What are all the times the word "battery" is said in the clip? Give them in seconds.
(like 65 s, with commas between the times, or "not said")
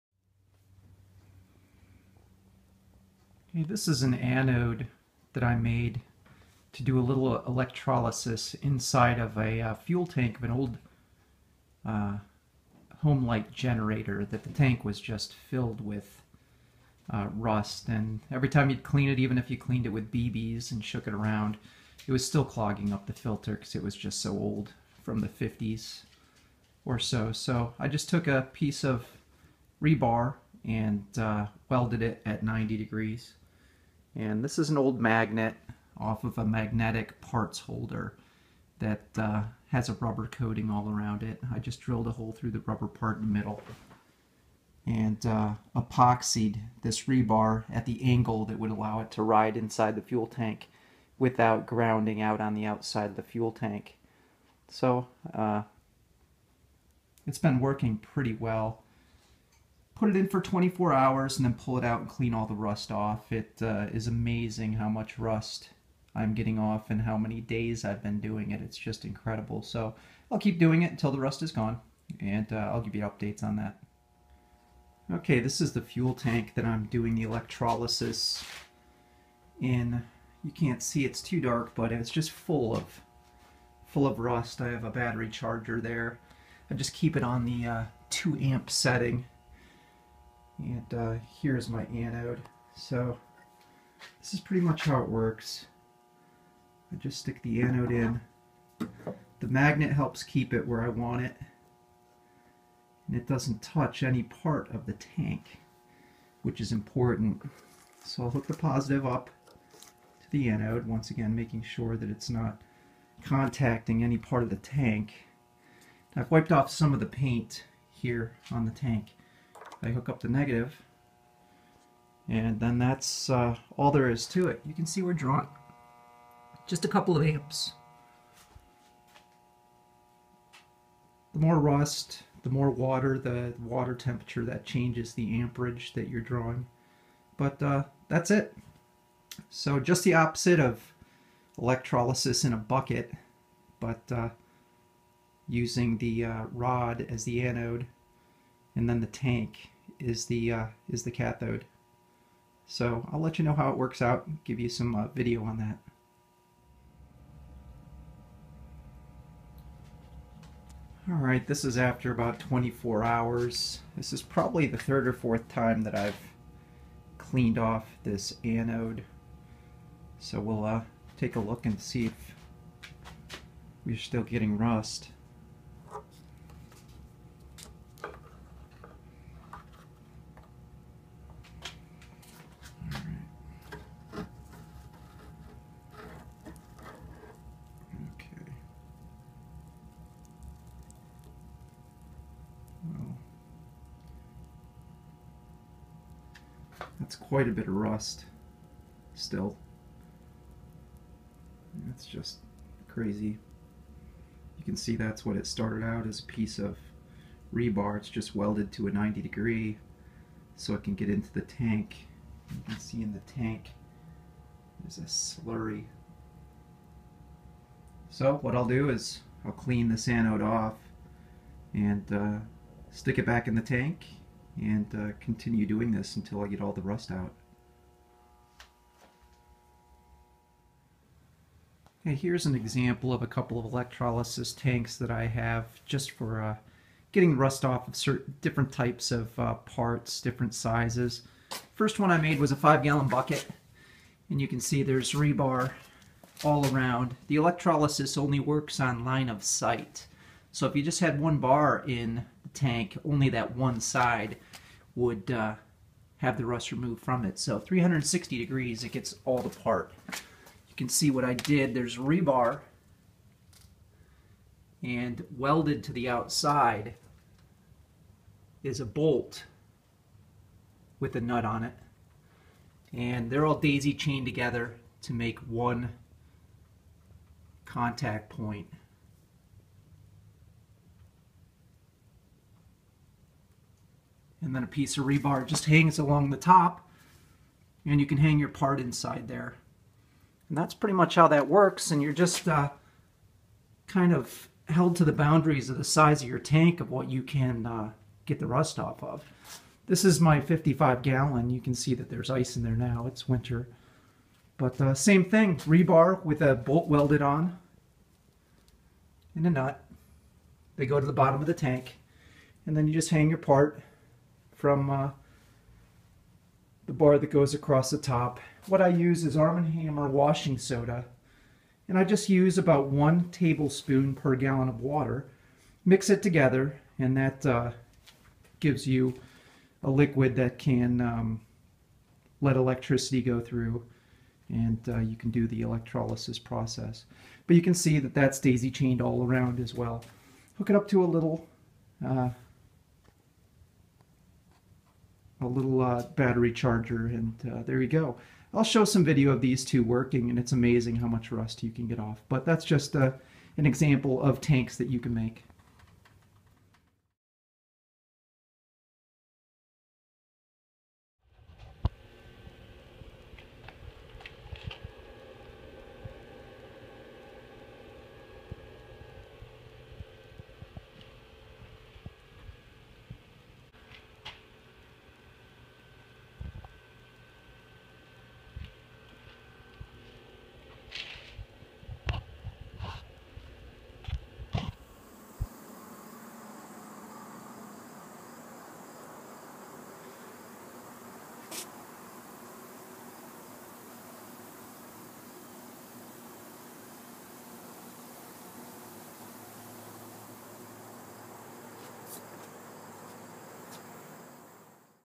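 84 s, 346 s.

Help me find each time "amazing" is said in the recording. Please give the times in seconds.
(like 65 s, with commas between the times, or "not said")
64 s, 350 s.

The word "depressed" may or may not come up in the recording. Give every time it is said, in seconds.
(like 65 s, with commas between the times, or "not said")
not said.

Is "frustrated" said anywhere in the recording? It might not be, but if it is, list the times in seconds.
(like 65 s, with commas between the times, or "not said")
not said.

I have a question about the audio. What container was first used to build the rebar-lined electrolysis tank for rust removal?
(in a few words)
five gallon bucket.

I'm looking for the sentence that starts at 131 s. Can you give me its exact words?
The more rust, the more water, the water temperature, that changes the amperage that you're drawing.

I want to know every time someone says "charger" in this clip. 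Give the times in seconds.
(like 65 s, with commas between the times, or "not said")
85 s, 346 s.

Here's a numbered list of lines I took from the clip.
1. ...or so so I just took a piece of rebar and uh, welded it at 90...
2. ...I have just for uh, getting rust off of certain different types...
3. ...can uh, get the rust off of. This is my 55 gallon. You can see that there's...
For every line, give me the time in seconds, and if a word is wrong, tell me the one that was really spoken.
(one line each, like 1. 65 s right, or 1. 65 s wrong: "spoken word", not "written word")
1. 26 s right
2. 235 s right
3. 297 s right.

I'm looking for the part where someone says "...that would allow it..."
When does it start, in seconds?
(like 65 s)
48 s.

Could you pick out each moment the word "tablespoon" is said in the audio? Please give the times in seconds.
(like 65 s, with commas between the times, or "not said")
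323 s.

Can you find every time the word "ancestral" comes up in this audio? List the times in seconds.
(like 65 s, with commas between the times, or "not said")
not said.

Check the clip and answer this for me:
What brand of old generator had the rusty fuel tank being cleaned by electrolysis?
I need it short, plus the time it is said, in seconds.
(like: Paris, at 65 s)
Homelite, at 13 s.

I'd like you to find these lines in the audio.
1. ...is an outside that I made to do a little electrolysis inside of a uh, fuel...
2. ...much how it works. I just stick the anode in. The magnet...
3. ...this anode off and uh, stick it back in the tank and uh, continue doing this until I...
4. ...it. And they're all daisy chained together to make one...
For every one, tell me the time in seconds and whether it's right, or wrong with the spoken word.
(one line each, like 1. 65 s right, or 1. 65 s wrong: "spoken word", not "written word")
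1. 3 s wrong: "anode", not "outside"
2. 94 s right
3. 219 s right
4. 271 s right.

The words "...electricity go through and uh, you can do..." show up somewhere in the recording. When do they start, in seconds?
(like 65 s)
332 s.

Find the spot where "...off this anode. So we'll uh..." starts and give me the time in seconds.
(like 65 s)
167 s.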